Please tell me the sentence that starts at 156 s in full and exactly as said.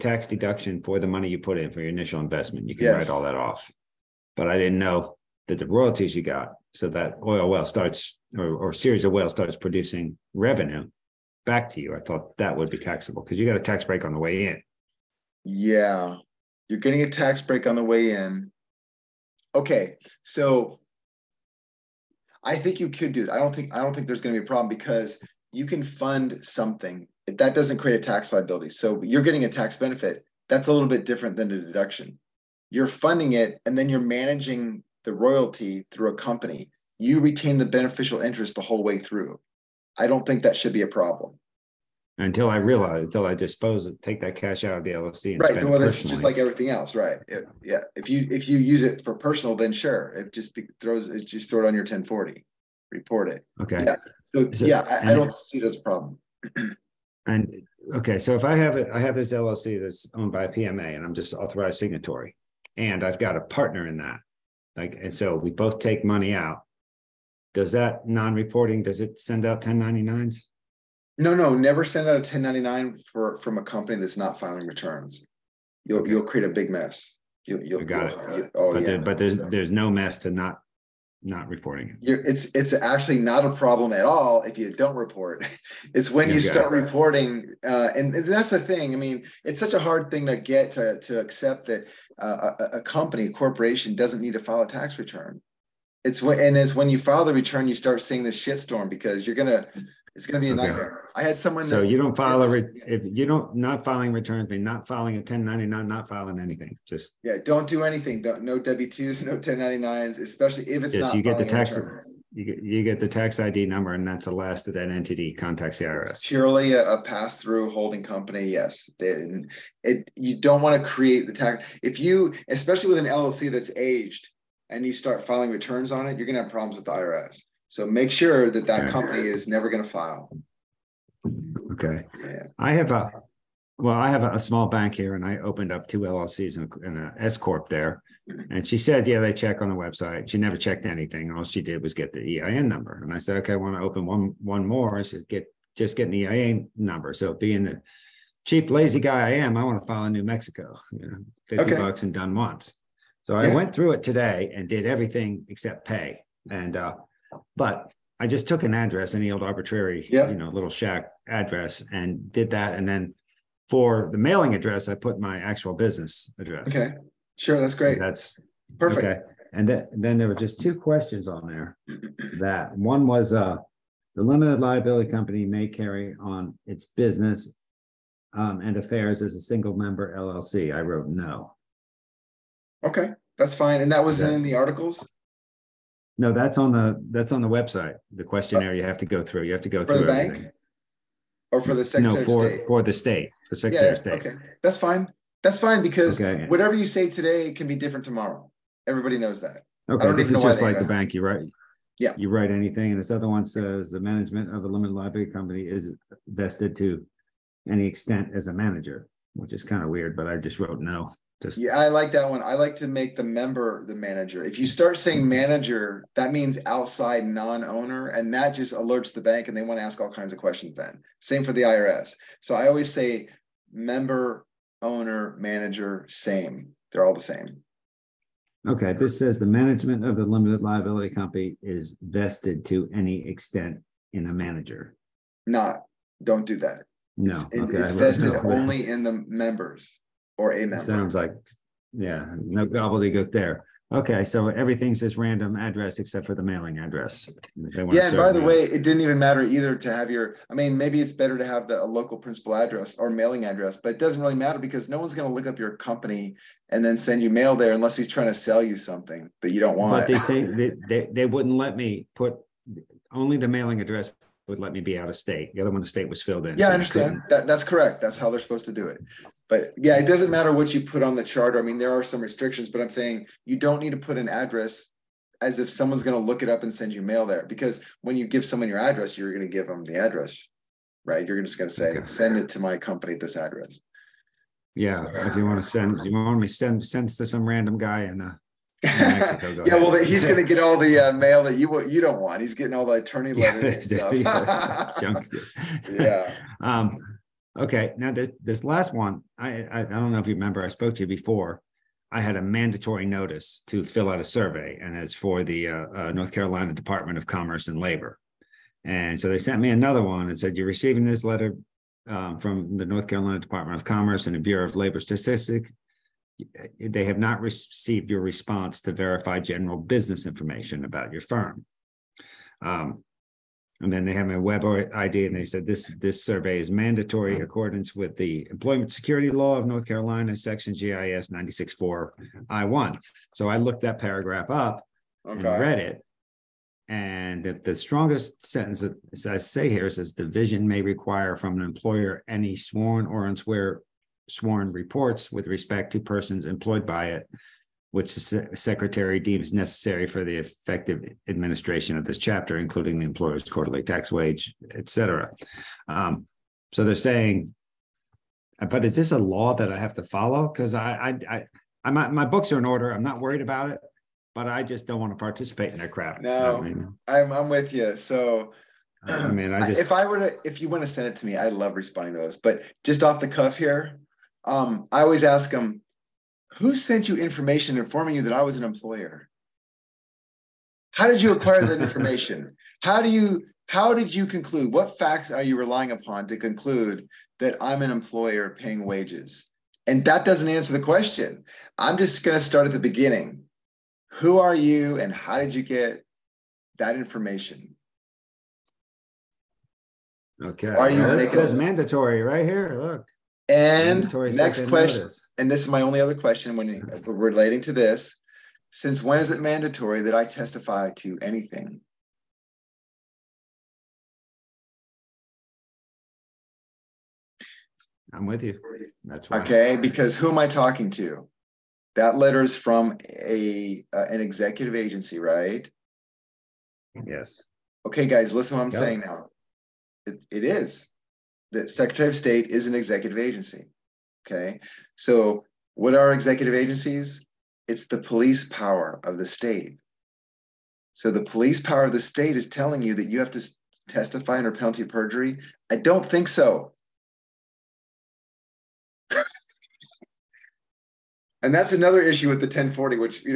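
And, uh, but I just took an address, any old arbitrary, yep.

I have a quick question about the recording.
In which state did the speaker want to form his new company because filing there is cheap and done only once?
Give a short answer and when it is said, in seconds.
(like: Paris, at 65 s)
New Mexico, at 150 s.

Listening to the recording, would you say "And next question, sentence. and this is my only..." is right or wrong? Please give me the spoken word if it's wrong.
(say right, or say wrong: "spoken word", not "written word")
wrong: "notice", not "sentence".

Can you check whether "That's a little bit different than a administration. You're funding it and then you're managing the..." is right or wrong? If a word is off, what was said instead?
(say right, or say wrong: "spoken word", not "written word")
wrong: "deduction", not "administration".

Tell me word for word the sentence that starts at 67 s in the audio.
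Does that non-reporting, does it send out 1099s?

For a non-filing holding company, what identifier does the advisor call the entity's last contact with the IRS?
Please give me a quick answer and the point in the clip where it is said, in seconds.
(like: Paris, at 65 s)
tax ID number, at 113 s.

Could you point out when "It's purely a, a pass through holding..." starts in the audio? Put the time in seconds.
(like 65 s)
116 s.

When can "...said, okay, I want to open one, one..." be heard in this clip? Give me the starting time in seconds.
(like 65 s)
143 s.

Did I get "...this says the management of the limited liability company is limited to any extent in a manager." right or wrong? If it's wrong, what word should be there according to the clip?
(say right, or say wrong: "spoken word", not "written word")
wrong: "vested", not "limited".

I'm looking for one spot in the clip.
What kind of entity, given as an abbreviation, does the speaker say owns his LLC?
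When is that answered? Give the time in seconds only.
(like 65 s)
60 s.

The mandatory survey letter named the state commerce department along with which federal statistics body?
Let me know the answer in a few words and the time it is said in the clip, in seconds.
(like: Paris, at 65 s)
Bureau of Labor Statistics, at 314 s.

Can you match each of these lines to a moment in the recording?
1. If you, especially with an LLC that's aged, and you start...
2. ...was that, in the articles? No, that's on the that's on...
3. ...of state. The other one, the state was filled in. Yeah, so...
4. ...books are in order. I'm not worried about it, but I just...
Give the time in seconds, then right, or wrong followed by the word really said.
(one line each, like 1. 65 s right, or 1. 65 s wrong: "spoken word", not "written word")
1. 121 s right
2. 184 s right
3. 265 s right
4. 362 s right.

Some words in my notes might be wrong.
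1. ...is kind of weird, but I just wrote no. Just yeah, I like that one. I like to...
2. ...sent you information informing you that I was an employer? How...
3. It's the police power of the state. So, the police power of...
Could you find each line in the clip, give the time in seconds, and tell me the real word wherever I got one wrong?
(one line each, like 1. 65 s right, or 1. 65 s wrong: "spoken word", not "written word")
1. 209 s right
2. 376 s right
3. 437 s right.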